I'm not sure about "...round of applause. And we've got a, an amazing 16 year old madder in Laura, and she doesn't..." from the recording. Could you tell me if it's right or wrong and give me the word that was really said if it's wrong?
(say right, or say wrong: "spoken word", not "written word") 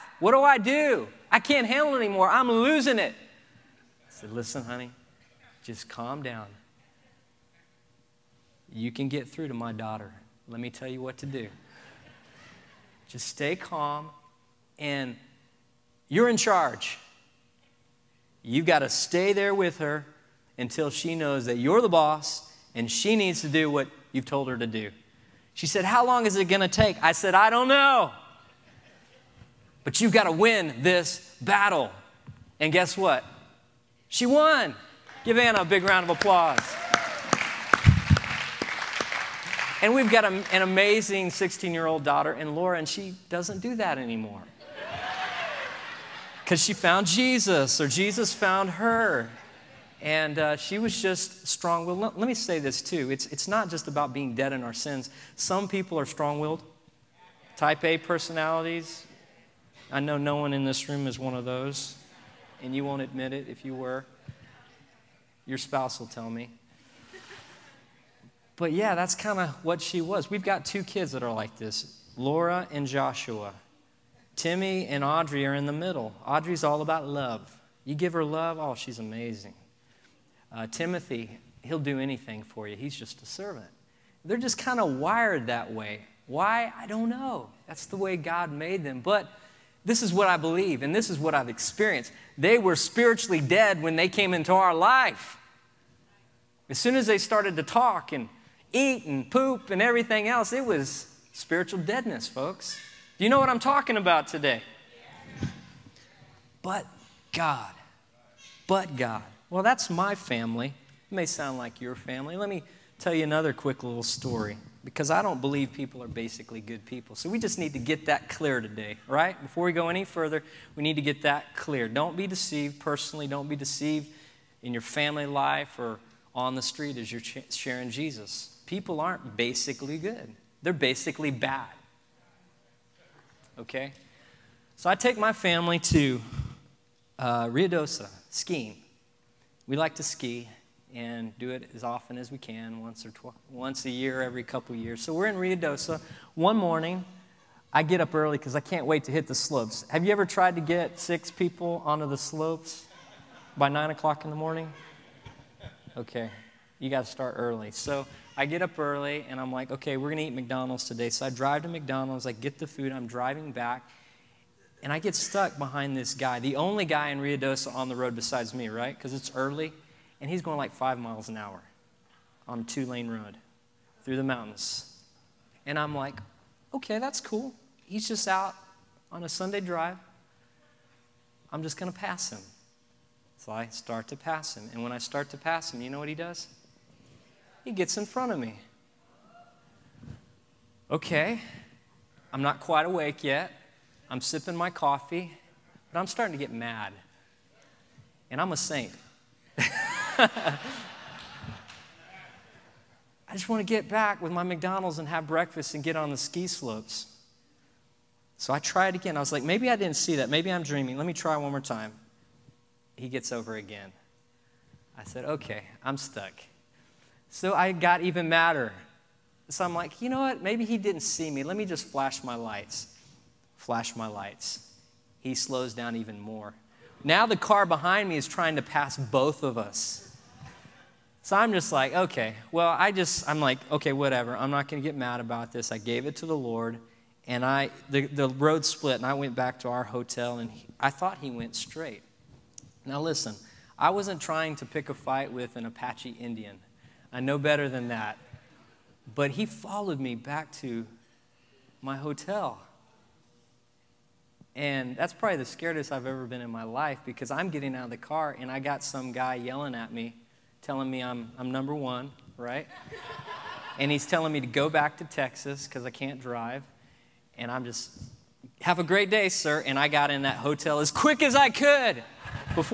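wrong: "daughter", not "madder".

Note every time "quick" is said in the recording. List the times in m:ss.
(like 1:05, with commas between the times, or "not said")
1:53, 4:30.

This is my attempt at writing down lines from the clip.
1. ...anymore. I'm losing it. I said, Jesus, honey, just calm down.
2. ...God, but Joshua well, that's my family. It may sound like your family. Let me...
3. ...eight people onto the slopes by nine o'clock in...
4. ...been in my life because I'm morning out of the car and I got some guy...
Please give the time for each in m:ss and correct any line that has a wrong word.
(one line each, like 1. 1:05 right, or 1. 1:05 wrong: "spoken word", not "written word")
1. 0:01 wrong: "Listen", not "Jesus"
2. 1:47 wrong: "God", not "Joshua"
3. 2:30 wrong: "six", not "eight"
4. 4:16 wrong: "getting", not "morning".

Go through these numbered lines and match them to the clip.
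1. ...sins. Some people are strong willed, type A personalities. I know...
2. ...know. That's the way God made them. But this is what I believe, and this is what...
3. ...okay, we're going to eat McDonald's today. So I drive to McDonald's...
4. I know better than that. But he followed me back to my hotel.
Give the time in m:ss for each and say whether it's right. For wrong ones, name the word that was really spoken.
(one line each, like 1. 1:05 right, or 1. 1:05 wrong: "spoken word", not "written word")
1. 0:54 right
2. 1:27 right
3. 2:39 right
4. 4:07 right.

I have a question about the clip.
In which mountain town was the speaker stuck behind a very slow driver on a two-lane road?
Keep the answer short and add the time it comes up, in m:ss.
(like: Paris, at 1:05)
Ruidoso, at 2:47.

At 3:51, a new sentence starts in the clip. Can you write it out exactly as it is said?
So I'm just like, okay, well, I just, I'm like, okay, whatever.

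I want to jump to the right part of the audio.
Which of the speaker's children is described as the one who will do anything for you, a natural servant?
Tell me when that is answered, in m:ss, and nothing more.
1:20.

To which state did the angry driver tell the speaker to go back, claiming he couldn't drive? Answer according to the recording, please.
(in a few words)
Texas.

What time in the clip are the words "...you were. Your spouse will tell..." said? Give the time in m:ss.
1:03.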